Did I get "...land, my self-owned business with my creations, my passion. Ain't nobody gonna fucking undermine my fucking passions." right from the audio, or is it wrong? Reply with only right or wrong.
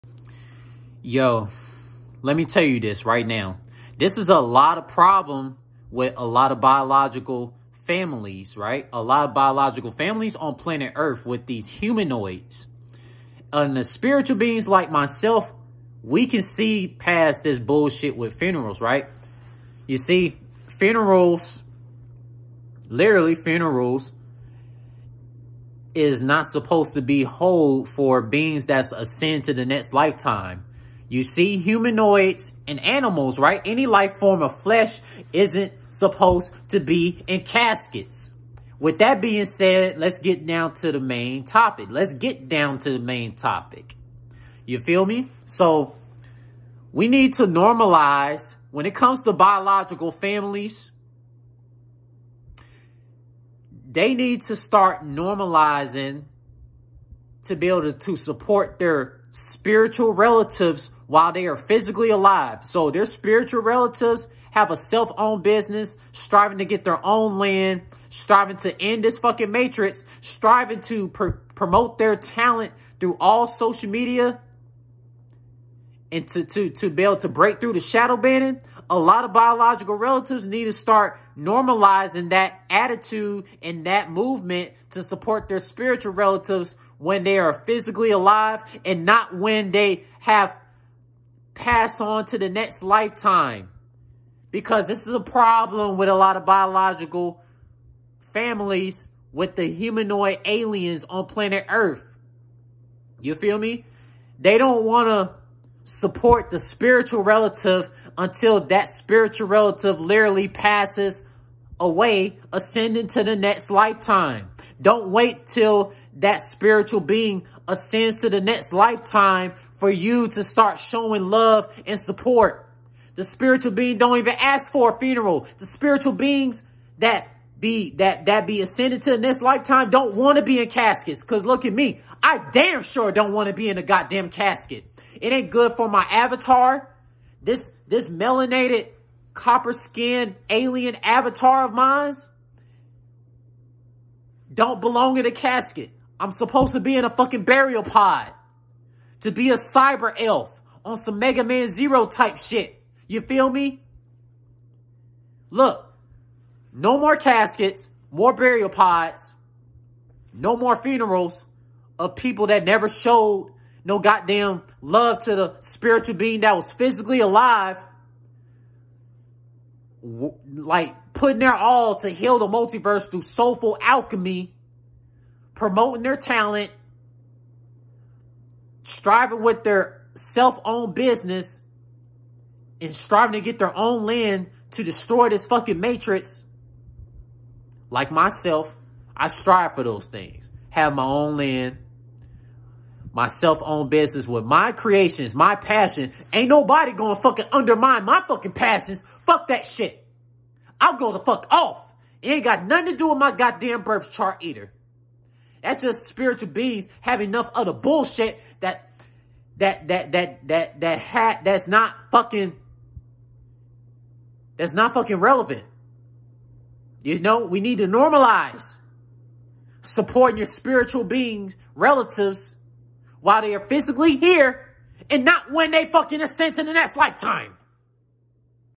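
right.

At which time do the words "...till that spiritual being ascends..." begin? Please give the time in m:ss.
1:55.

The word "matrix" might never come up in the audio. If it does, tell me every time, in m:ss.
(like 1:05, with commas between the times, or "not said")
1:09, 3:05.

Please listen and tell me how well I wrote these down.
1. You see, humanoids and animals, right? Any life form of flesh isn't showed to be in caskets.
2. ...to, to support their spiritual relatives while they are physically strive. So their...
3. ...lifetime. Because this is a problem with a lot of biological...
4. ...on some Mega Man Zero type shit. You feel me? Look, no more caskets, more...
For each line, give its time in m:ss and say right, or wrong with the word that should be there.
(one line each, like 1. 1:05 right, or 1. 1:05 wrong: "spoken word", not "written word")
1. 0:31 wrong: "supposed", not "showed"
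2. 0:57 wrong: "alive", not "strive"
3. 1:32 right
4. 2:30 right.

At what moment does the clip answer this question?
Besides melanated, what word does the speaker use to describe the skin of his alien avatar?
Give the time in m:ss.
2:19.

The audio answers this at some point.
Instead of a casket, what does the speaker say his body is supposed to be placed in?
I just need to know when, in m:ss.
2:27.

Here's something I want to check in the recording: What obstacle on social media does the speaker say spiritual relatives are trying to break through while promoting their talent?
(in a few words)
shadow banning.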